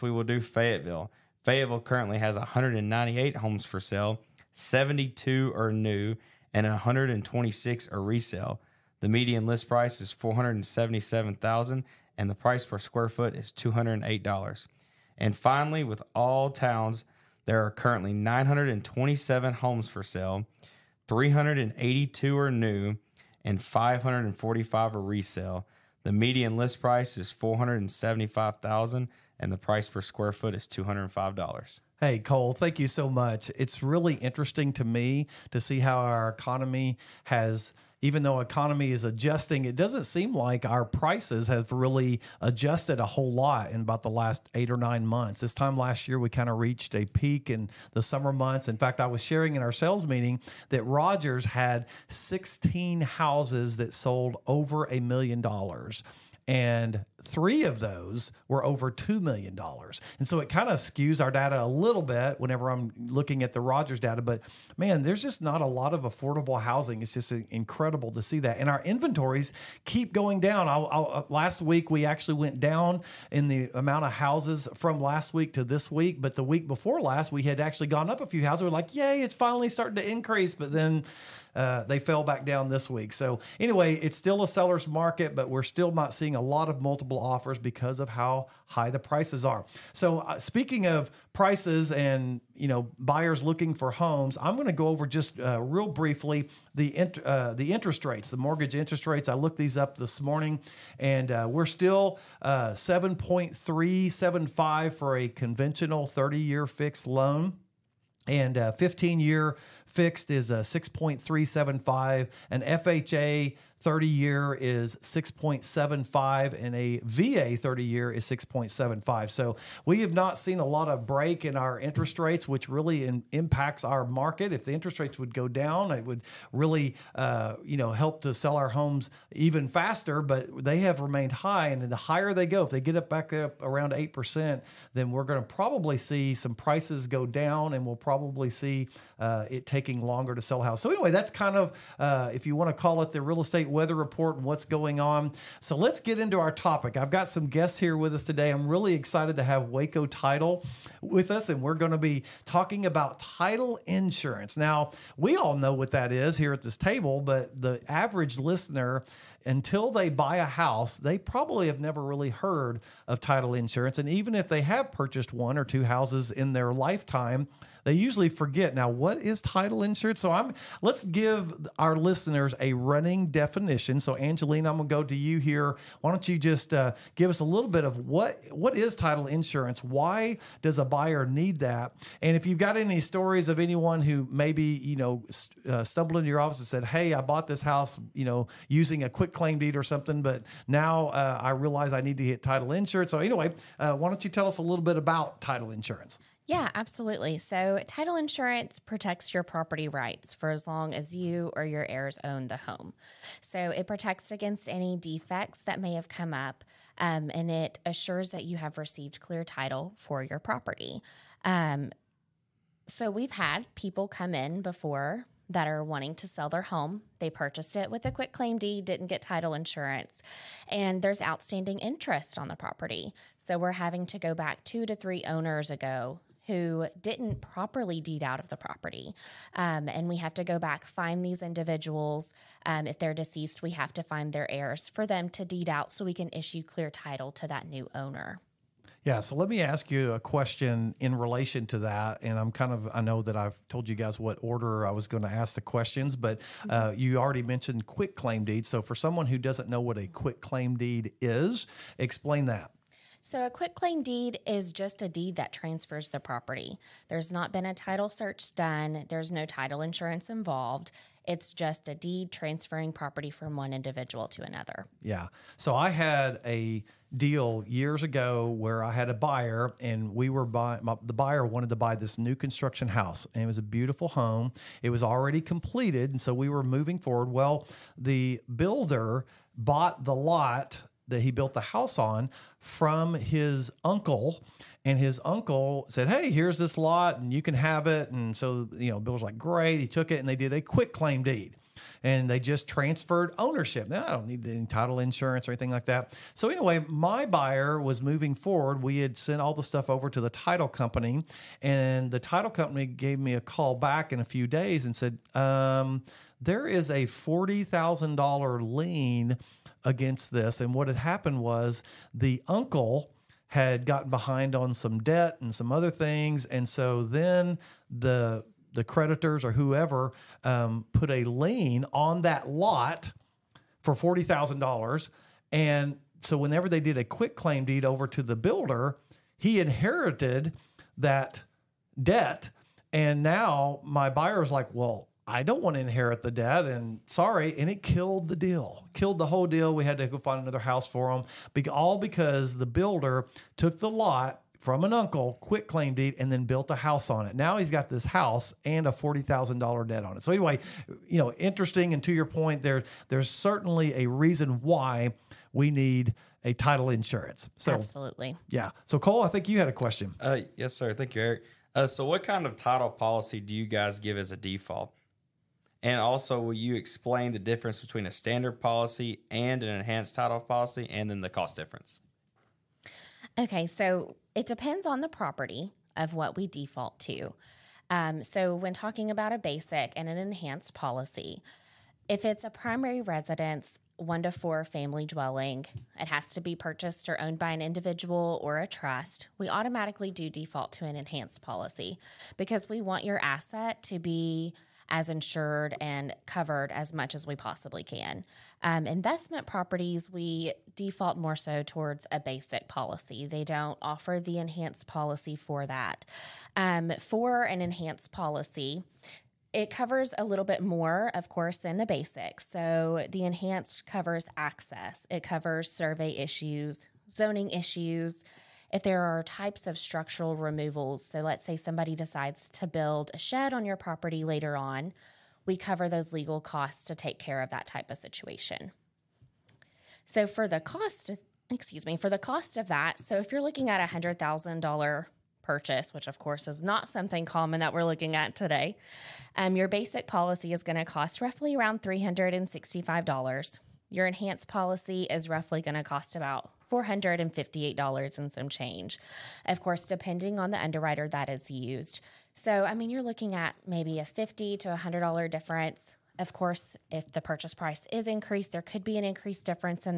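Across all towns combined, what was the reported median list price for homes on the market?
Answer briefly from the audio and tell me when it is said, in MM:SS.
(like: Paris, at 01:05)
$475,000, at 00:27.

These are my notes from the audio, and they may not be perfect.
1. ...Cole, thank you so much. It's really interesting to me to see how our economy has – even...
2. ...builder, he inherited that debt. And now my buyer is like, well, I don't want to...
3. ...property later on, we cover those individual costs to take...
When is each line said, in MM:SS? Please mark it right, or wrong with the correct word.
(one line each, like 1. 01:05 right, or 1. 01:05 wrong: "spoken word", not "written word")
1. 00:32 right
2. 05:28 right
3. 07:03 wrong: "legal", not "individual".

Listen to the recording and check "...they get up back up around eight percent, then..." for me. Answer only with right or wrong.
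right.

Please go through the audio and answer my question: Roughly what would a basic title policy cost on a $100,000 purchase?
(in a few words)
$365.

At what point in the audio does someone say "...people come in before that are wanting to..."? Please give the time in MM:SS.
03:33.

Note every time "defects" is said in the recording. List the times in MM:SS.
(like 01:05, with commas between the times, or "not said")
03:24.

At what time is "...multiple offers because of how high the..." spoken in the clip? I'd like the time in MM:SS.
01:26.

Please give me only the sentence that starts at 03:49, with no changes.
Um, and we have to go back, find these individuals.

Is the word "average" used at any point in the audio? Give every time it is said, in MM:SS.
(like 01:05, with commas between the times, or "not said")
02:37.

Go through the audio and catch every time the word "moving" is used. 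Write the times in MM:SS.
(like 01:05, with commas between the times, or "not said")
04:36, 04:58.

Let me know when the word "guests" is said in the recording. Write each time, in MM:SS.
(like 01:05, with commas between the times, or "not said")
02:27.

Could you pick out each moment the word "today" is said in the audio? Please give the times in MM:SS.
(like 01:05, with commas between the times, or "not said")
02:28, 07:18.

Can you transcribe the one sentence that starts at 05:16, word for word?
And so then the the creditors or whoever um, put a lien on that lot for forty thousand dollars.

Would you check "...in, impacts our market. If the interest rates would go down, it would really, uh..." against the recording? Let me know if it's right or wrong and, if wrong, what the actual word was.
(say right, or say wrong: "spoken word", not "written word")
right.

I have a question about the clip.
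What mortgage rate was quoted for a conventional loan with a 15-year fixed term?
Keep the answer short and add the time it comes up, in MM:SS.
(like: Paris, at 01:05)
6.375, at 01:50.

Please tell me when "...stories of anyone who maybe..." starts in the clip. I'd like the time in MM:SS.
03:03.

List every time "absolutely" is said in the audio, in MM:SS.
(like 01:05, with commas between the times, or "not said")
03:16, 05:57.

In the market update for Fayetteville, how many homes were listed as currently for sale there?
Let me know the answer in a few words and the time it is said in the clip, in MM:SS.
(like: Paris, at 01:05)
198, at 00:02.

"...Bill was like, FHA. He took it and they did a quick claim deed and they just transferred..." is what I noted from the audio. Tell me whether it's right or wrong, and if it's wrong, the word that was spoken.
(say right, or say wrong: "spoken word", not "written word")
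wrong: "Great", not "FHA".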